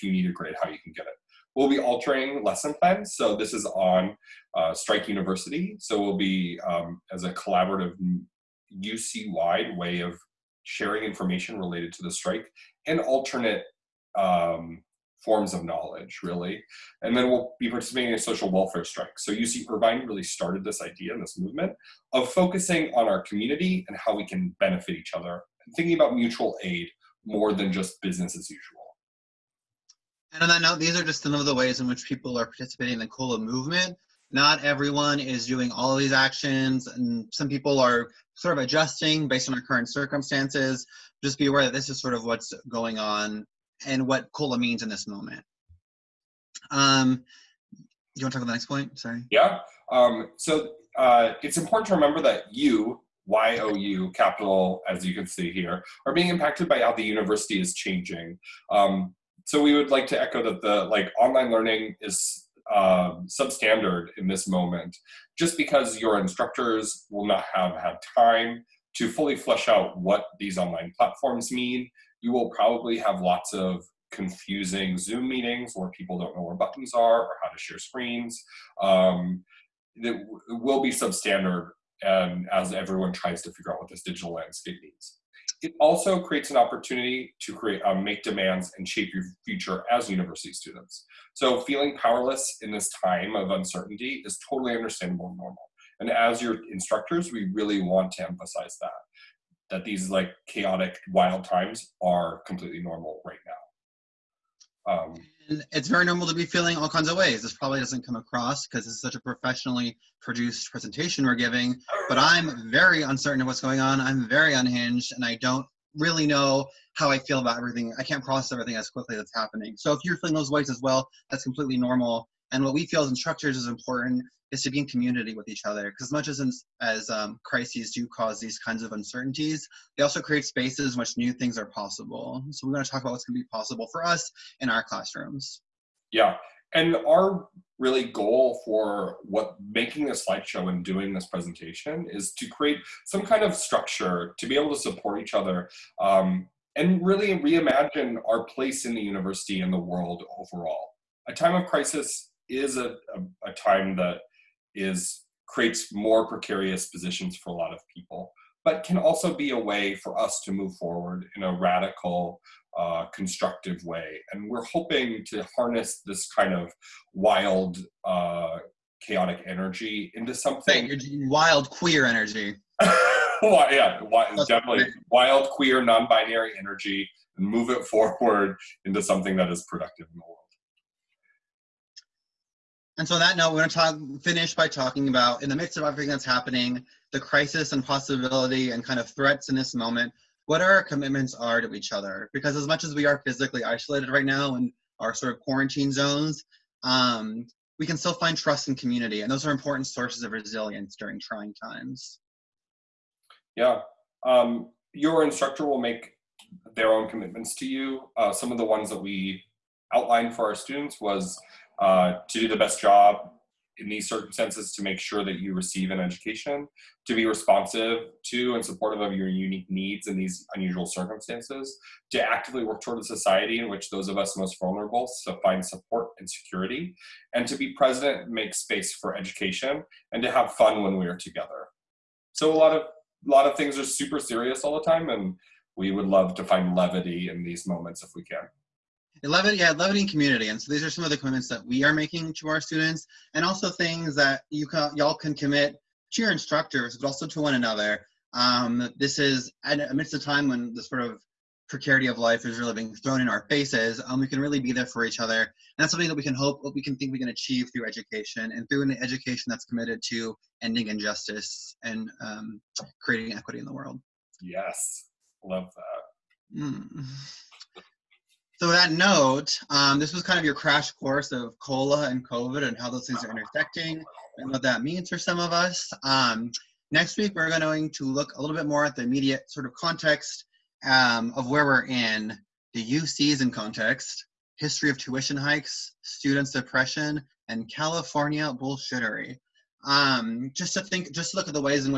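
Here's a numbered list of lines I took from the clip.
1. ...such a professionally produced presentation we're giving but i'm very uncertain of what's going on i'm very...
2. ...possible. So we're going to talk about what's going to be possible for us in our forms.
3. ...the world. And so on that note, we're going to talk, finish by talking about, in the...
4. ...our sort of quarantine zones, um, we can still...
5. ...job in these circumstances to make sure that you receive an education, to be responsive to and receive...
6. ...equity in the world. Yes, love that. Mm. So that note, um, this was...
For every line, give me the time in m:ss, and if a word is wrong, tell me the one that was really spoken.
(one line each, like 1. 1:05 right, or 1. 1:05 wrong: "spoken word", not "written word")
1. 1:49 right
2. 2:11 wrong: "classrooms", not "forms"
3. 3:00 right
4. 3:15 right
5. 3:32 wrong: "supportive", not "receive"
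6. 4:23 right.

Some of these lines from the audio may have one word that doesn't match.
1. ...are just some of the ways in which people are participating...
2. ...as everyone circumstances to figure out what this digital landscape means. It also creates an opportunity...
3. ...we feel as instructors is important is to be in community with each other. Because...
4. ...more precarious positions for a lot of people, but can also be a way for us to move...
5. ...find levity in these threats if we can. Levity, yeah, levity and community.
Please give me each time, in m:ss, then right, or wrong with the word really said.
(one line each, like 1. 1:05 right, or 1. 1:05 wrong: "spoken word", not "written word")
1. 0:31 right
2. 1:22 wrong: "tries", not "circumstances"
3. 2:02 right
4. 2:35 right
5. 3:56 wrong: "moments", not "threats".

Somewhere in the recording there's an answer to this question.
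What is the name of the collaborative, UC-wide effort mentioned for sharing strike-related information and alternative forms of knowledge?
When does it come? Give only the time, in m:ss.
0:04.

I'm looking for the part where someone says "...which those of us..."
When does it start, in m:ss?
3:43.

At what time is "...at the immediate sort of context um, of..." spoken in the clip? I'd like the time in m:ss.
4:38.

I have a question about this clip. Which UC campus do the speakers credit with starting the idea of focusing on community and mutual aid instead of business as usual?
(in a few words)
UC Irvine.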